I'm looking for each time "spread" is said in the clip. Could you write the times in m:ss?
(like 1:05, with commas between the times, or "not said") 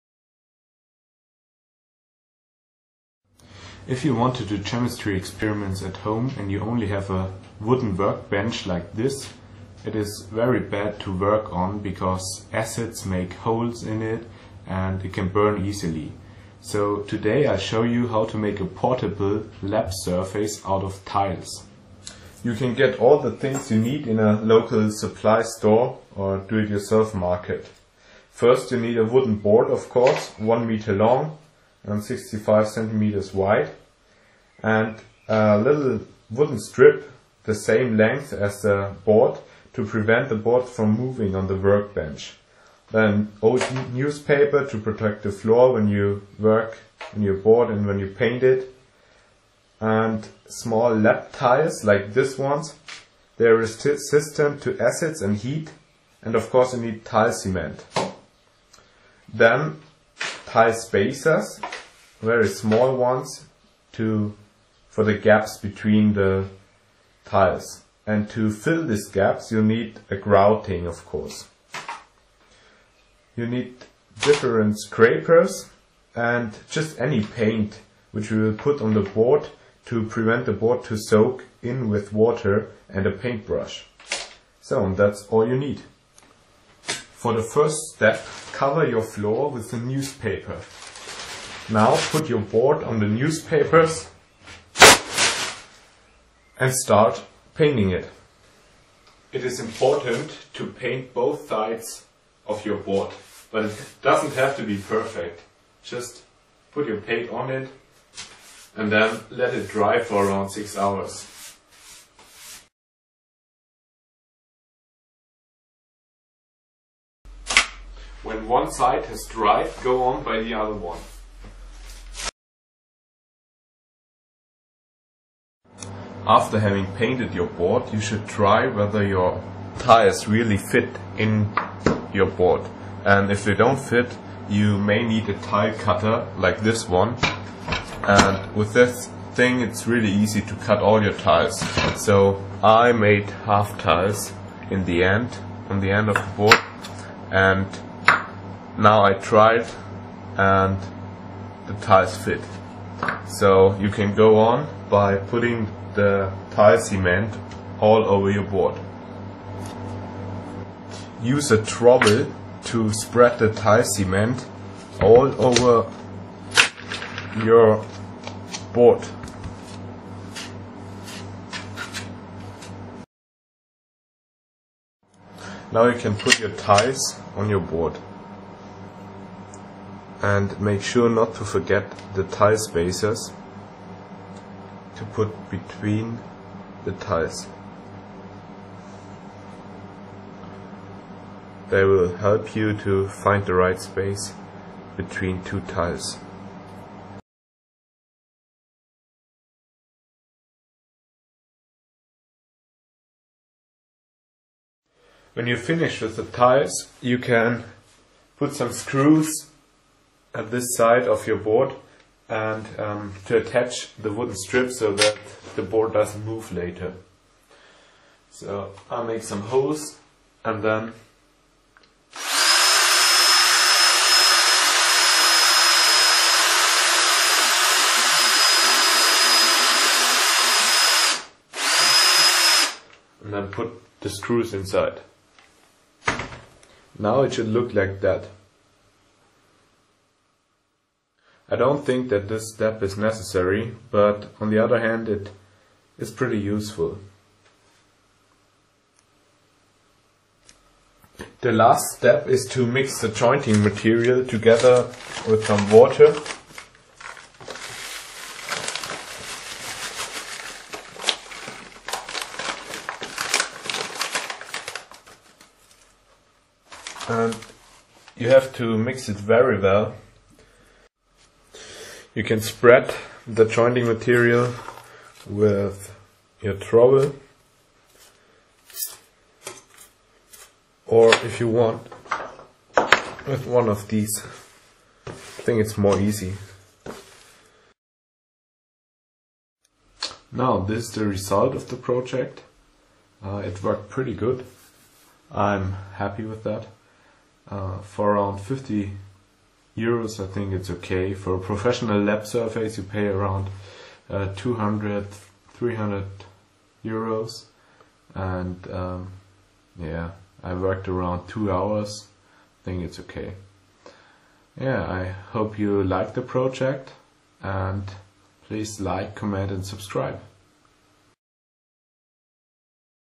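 2:42, 4:32.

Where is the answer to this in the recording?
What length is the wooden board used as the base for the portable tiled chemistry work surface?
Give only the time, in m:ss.
0:30.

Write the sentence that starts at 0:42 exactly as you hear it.
Then old newspaper to protect the floor when you work on your board and when you paint it.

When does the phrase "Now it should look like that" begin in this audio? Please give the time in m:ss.
3:56.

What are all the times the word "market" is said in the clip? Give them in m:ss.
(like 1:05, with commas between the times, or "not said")
0:27.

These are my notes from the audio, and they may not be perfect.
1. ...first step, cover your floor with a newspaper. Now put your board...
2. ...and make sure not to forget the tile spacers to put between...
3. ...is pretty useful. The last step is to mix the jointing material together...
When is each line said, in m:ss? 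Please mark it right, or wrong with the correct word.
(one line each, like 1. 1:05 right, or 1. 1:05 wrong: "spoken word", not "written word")
1. 1:27 right
2. 3:00 right
3. 4:05 right.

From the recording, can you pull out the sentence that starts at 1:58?
When one side has dried, go on by the other one.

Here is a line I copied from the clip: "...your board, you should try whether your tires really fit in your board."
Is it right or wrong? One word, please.
right.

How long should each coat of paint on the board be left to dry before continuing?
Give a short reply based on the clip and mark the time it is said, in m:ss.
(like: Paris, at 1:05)
6 hours, at 1:50.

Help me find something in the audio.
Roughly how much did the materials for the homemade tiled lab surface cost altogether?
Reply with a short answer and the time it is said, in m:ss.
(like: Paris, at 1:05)
50 euros, at 4:58.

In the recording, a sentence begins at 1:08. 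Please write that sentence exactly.
And to fill these gaps you need a grouting of course.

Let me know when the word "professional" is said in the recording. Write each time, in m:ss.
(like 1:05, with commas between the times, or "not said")
5:01.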